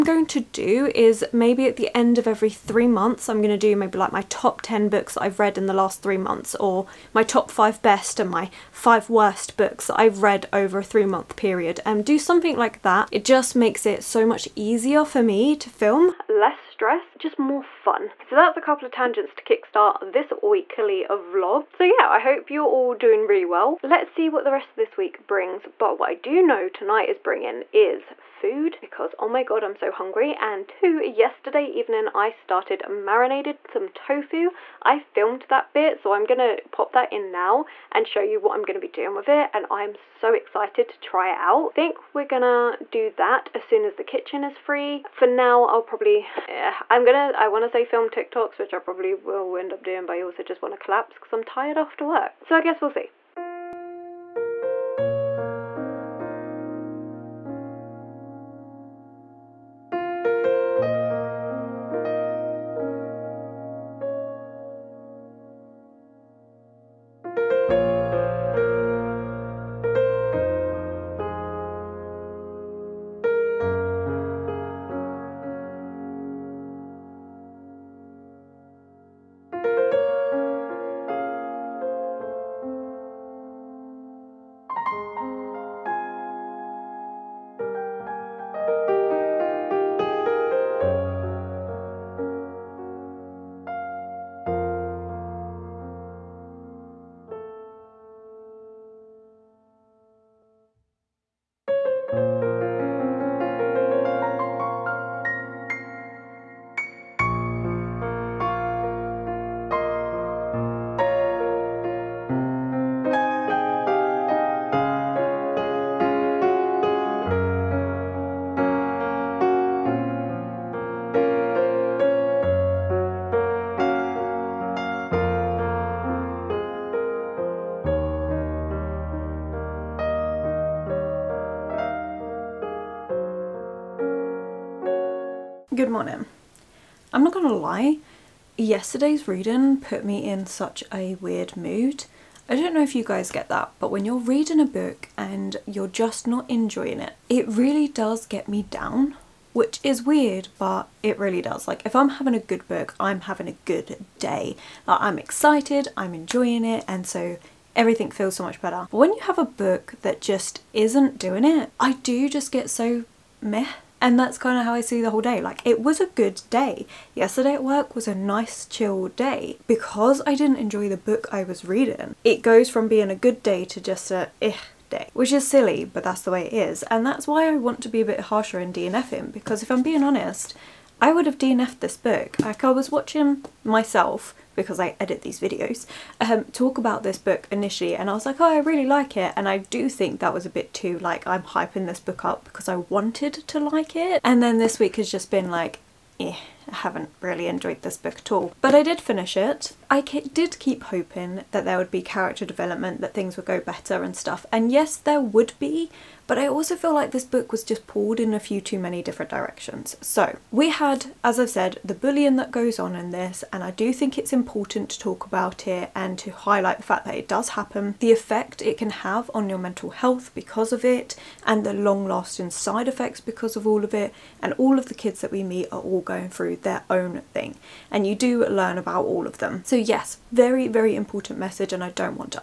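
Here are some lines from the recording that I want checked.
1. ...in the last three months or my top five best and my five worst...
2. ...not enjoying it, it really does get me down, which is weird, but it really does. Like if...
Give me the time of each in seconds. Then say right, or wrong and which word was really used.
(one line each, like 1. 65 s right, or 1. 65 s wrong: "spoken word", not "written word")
1. 5 s right
2. 146 s right.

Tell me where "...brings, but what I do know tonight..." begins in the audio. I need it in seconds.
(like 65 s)
25 s.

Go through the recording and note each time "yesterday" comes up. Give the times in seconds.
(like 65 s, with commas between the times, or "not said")
31 s, 138 s, 167 s.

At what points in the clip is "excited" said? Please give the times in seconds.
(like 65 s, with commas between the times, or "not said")
40 s, 155 s.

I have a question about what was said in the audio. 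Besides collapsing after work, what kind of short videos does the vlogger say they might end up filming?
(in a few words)
TikToks.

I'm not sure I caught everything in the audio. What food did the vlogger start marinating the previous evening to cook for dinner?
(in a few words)
Tofu.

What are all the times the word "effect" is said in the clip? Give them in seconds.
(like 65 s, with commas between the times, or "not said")
218 s, 222 s.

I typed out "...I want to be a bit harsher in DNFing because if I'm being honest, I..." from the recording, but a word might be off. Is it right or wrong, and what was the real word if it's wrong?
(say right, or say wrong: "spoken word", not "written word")
right.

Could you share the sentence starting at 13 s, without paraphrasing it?
It just makes it so much easier for me to film, less stress, just more fun.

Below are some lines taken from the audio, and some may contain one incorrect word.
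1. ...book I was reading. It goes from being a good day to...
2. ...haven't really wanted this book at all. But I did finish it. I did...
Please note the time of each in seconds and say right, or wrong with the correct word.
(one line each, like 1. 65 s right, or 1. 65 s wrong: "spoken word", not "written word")
1. 170 s right
2. 196 s wrong: "enjoyed", not "wanted".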